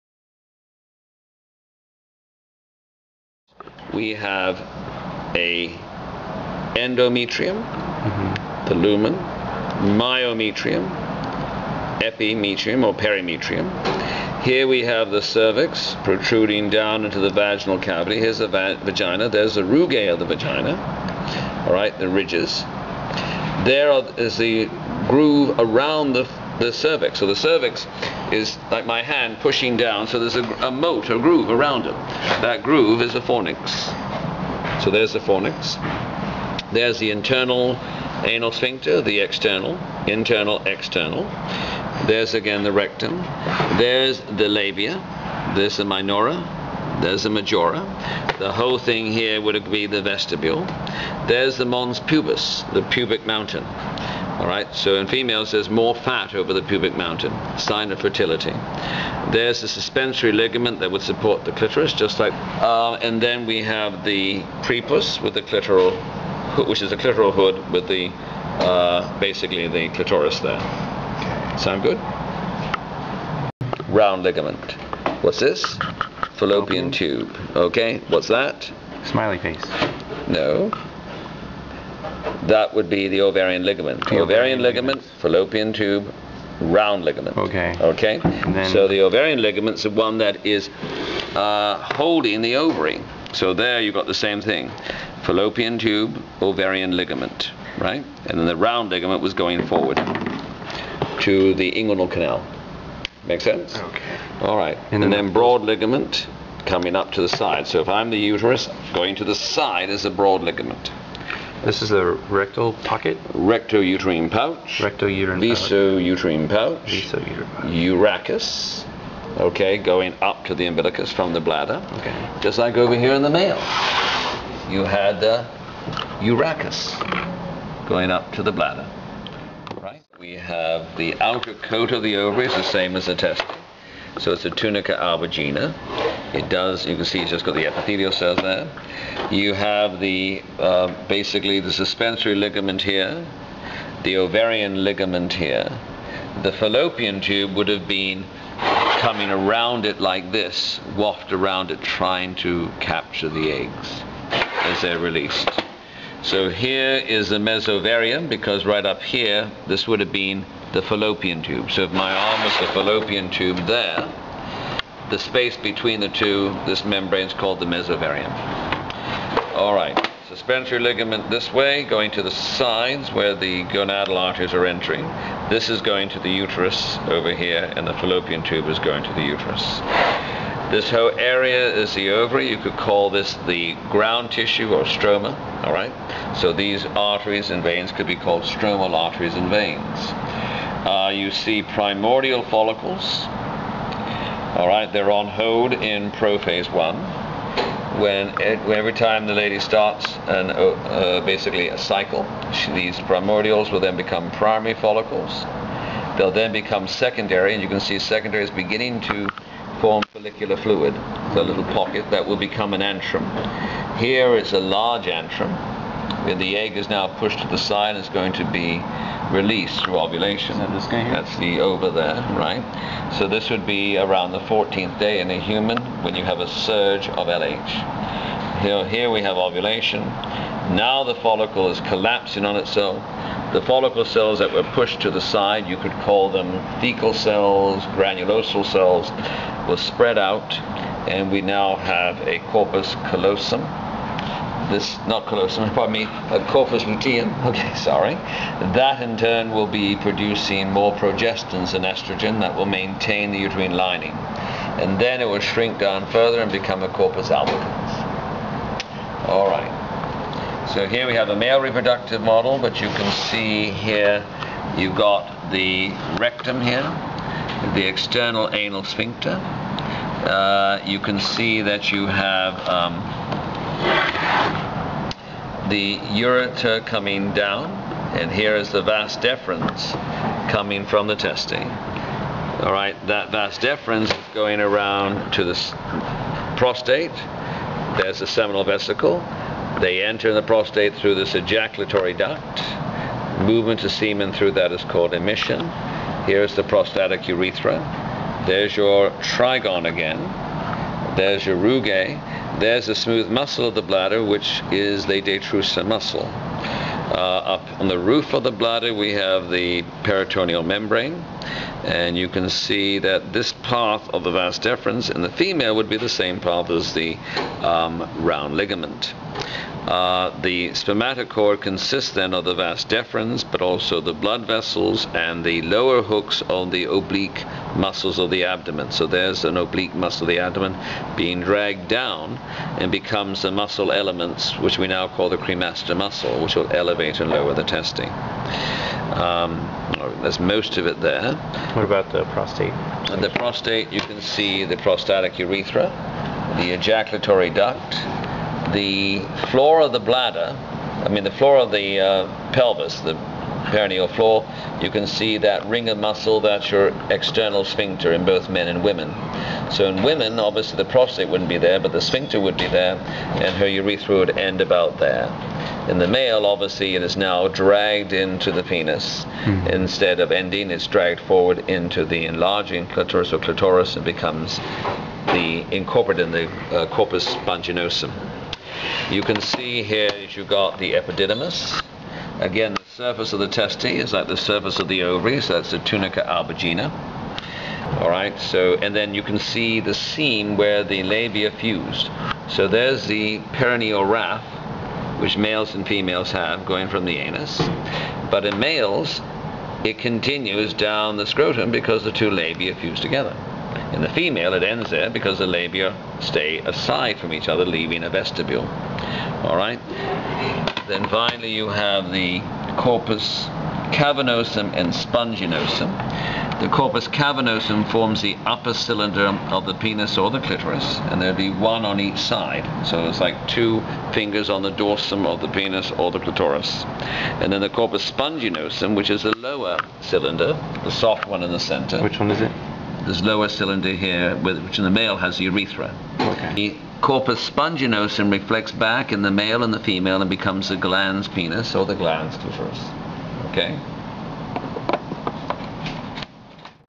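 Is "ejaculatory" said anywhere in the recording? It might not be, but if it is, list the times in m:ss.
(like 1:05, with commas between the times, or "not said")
4:51, 5:46.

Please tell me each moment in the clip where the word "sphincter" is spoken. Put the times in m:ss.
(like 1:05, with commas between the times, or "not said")
0:38, 4:28, 5:57, 6:02.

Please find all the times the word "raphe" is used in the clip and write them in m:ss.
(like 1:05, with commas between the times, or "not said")
6:34.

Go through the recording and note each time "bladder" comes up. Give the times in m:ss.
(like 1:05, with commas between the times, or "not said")
2:01, 2:08, 5:03, 5:08, 5:49.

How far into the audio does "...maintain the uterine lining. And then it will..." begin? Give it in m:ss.
4:12.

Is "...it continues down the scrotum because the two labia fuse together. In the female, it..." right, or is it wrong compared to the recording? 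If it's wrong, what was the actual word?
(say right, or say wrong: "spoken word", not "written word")
right.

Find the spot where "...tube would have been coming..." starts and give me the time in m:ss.
2:27.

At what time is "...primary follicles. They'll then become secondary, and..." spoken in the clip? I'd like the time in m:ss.
3:24.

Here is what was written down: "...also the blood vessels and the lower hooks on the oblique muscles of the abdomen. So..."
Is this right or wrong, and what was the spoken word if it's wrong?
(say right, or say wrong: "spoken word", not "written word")
right.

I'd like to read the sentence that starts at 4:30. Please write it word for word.
Uh, you can see that you have um, the ureter coming down, and here is the vas deferens coming from the testing.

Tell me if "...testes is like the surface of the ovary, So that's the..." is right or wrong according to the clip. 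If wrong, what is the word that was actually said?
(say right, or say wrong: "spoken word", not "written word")
right.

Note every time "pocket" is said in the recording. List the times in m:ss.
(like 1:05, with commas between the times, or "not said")
1:52, 3:31.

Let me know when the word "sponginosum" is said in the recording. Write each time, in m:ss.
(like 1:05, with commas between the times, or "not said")
6:17, 6:54, 7:08, 7:17.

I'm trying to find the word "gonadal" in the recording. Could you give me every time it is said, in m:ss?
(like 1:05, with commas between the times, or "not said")
2:53.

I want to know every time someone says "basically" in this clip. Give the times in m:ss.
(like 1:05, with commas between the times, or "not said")
1:09, 2:21, 3:21.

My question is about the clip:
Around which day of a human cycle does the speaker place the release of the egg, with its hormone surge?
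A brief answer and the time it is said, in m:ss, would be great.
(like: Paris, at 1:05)
14th day, at 3:43.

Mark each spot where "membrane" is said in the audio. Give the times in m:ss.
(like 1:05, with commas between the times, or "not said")
2:46, 5:10.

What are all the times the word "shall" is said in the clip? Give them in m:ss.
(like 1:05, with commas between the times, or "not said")
not said.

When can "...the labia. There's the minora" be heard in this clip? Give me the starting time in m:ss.
0:44.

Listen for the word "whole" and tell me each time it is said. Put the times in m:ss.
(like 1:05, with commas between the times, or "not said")
0:48, 3:00.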